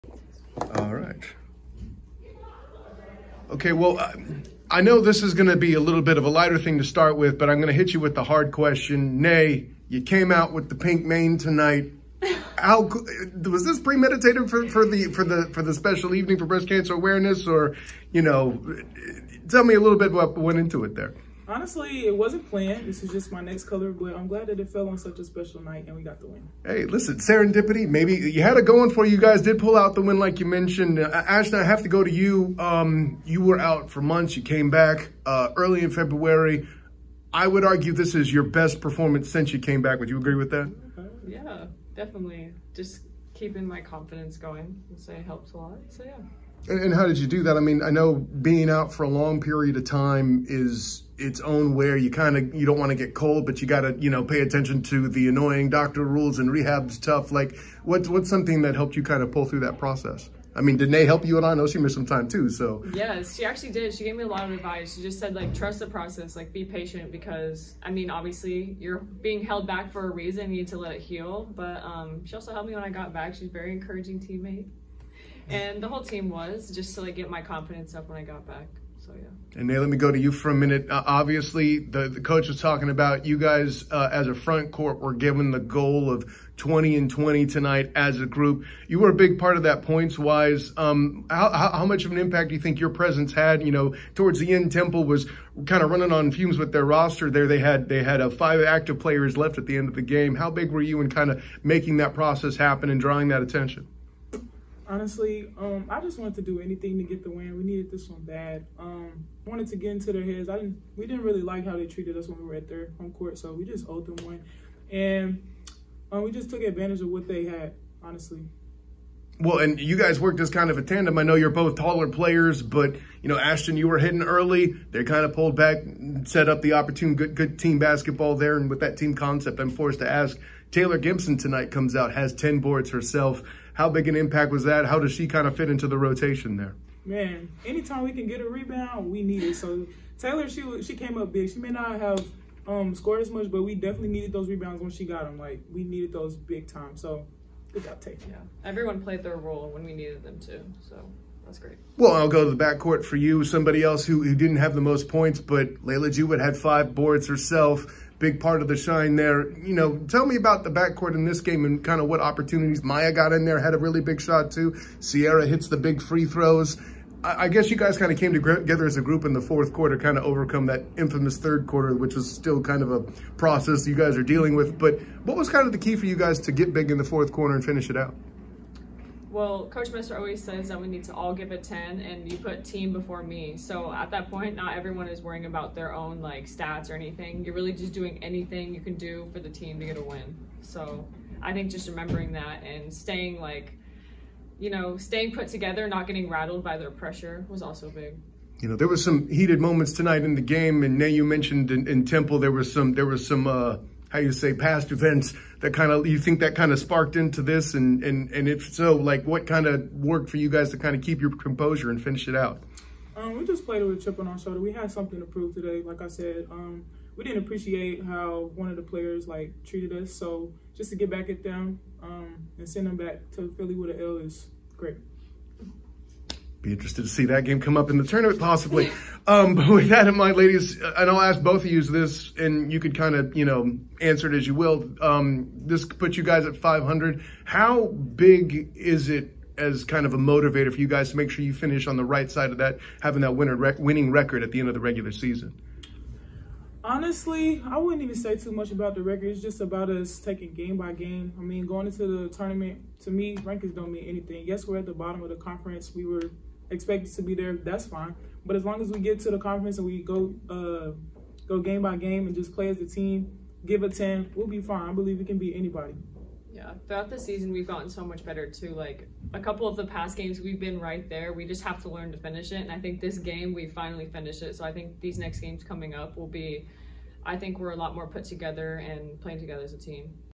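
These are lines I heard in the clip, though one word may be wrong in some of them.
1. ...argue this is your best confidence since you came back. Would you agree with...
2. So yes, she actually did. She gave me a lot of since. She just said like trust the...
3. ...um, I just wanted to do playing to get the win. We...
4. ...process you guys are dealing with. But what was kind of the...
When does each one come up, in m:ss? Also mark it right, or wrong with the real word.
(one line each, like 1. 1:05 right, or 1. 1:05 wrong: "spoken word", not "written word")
1. 0:37 wrong: "performance", not "confidence"
2. 1:02 wrong: "advice", not "since"
3. 1:45 wrong: "anything", not "playing"
4. 2:53 right.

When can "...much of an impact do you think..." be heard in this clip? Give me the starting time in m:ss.
1:31.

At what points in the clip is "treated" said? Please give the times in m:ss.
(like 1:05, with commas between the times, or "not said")
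1:51, 3:39.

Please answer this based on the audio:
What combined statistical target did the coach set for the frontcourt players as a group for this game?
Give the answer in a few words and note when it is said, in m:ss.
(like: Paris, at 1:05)
20 and 20, at 1:26.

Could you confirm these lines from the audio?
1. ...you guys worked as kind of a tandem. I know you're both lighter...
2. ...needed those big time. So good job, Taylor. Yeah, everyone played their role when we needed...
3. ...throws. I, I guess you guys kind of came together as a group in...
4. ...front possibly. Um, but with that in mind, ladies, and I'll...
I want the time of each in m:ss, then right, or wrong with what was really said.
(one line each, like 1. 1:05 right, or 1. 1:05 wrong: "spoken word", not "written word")
1. 1:59 wrong: "taller", not "lighter"
2. 2:25 right
3. 2:46 right
4. 3:48 wrong: "tournament", not "front".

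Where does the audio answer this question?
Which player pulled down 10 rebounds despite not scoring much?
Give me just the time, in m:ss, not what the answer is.
2:10.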